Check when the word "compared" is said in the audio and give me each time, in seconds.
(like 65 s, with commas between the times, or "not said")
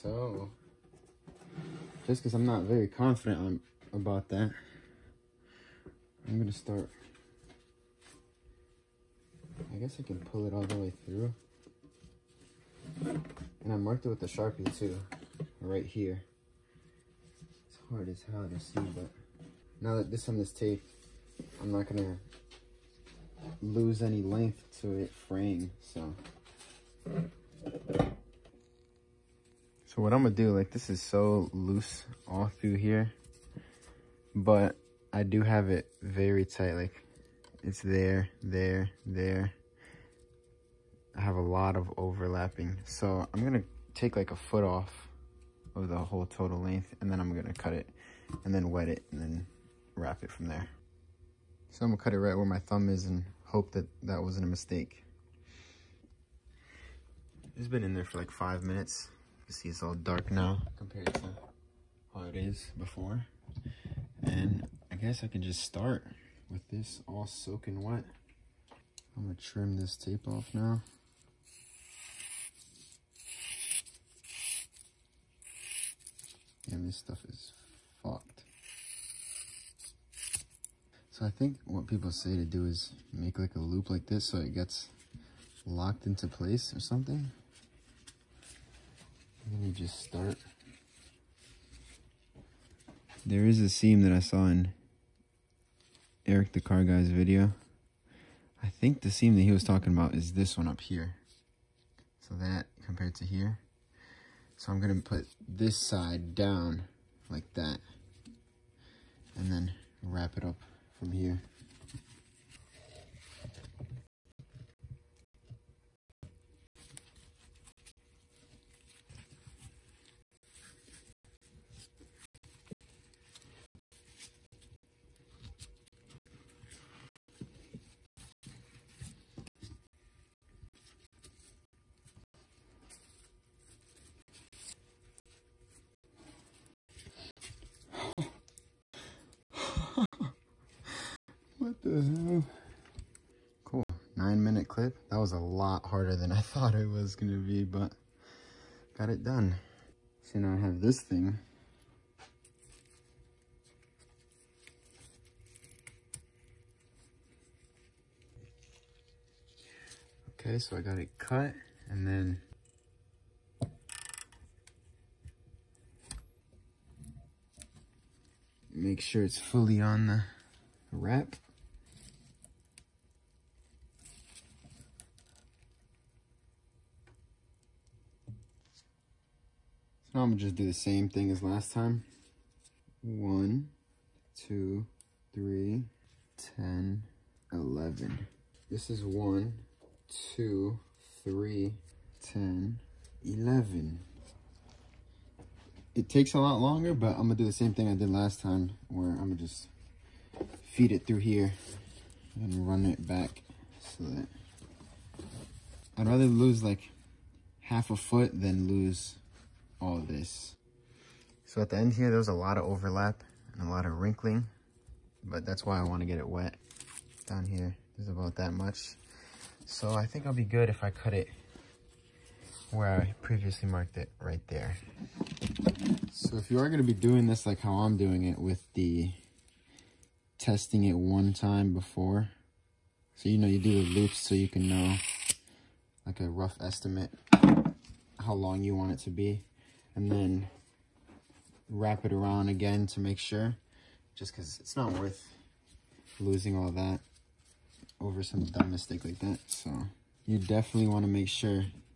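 60 s, 102 s.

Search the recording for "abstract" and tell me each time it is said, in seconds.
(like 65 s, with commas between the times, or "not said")
not said.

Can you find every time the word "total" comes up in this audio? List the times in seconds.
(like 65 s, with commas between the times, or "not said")
46 s.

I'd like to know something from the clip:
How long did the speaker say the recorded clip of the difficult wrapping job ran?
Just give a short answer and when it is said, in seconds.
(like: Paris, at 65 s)
9 minutes, at 144 s.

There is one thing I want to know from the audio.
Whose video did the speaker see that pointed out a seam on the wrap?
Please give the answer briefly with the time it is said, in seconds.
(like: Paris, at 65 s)
Eric the Car Guy, at 96 s.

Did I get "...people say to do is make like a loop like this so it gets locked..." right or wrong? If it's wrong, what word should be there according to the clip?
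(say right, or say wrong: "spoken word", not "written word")
right.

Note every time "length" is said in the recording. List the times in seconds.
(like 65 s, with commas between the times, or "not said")
24 s, 46 s.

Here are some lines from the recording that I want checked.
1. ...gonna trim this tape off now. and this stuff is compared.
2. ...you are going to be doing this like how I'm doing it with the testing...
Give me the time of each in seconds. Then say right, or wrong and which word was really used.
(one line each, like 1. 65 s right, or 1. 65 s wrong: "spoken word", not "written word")
1. 69 s wrong: "fucked", not "compared"
2. 226 s right.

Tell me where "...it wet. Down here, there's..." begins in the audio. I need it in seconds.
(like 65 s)
216 s.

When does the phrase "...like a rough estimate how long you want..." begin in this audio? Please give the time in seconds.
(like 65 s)
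236 s.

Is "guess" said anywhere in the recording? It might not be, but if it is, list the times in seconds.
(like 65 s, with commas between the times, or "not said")
9 s, 64 s.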